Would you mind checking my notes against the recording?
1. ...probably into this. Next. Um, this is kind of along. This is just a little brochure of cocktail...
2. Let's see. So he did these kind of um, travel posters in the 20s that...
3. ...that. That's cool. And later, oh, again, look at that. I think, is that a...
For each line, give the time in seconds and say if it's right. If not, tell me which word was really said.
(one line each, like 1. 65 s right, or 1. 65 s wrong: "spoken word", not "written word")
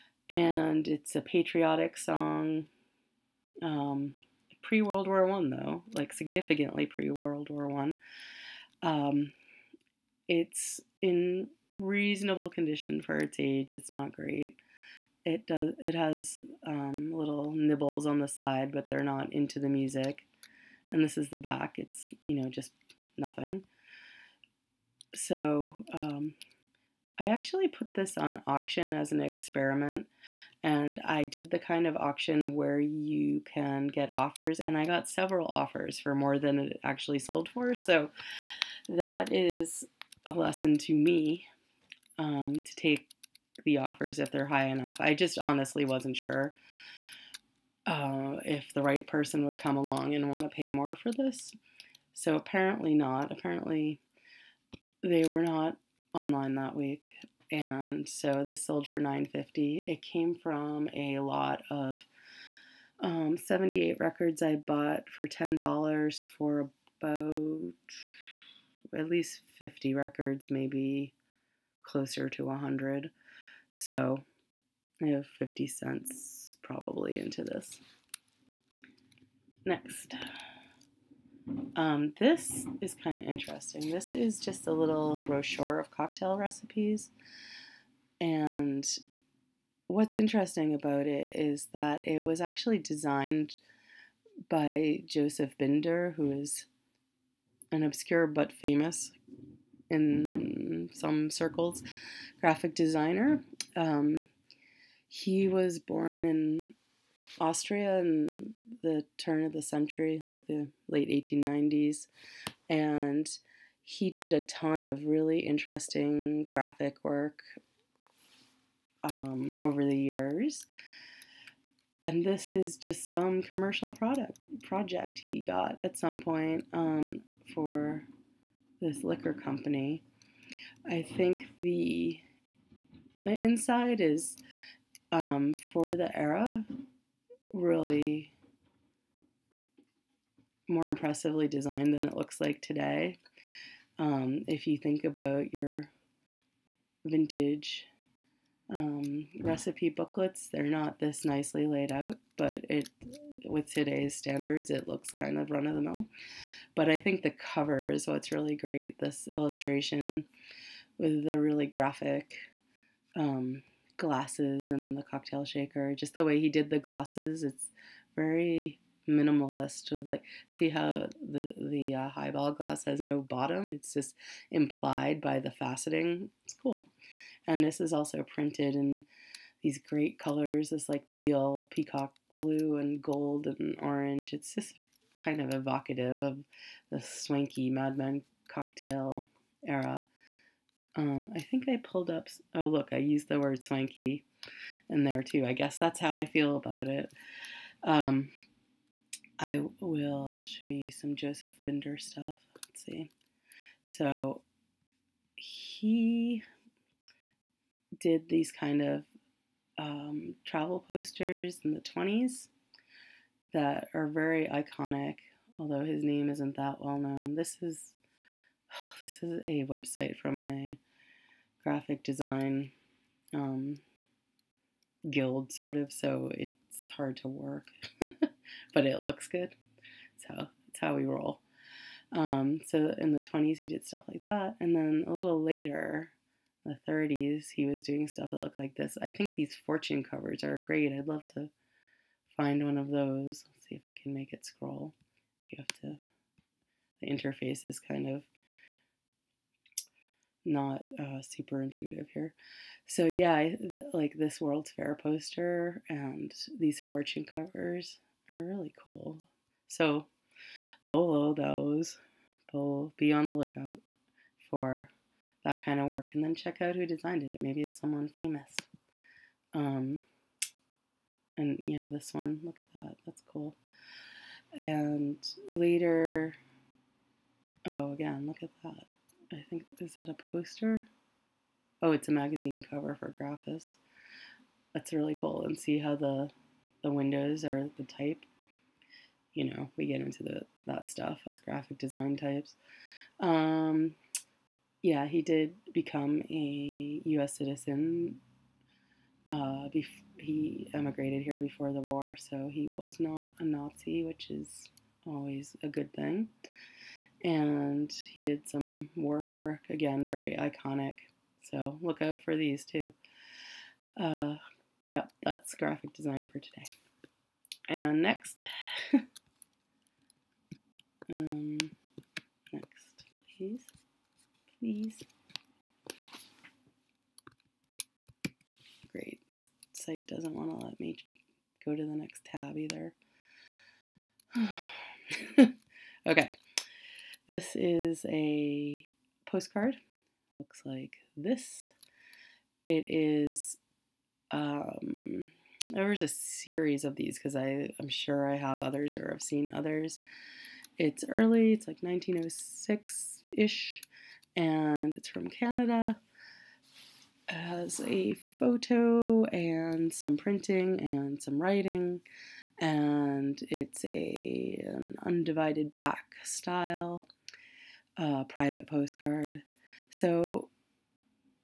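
1. 76 s wrong: "interesting", not "along"
2. 202 s right
3. 272 s right.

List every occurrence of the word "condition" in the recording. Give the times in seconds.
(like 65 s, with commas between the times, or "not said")
12 s.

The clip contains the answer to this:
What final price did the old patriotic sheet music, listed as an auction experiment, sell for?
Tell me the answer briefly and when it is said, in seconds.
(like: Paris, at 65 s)
950, at 58 s.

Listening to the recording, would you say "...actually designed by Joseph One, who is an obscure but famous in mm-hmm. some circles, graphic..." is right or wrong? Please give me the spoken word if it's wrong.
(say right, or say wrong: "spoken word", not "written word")
wrong: "Binder", not "One".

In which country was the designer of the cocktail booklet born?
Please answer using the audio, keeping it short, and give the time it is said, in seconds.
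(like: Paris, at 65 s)
Austria, at 107 s.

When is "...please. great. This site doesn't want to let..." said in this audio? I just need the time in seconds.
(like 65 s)
324 s.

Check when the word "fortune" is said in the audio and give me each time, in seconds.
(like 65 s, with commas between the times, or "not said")
239 s, 256 s.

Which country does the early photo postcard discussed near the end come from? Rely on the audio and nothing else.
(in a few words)
Canada.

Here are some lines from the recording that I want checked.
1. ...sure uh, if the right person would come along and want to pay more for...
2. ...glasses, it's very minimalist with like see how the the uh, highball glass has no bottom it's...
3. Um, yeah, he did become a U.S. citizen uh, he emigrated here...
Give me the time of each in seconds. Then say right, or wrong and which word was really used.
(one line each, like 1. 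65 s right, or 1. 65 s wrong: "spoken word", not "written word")
1. 46 s right
2. 166 s right
3. 293 s right.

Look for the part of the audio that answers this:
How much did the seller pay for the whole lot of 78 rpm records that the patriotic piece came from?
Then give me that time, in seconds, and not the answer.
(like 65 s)
65 s.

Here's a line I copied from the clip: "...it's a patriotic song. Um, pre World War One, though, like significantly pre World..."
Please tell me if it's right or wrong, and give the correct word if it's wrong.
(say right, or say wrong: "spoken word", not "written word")
right.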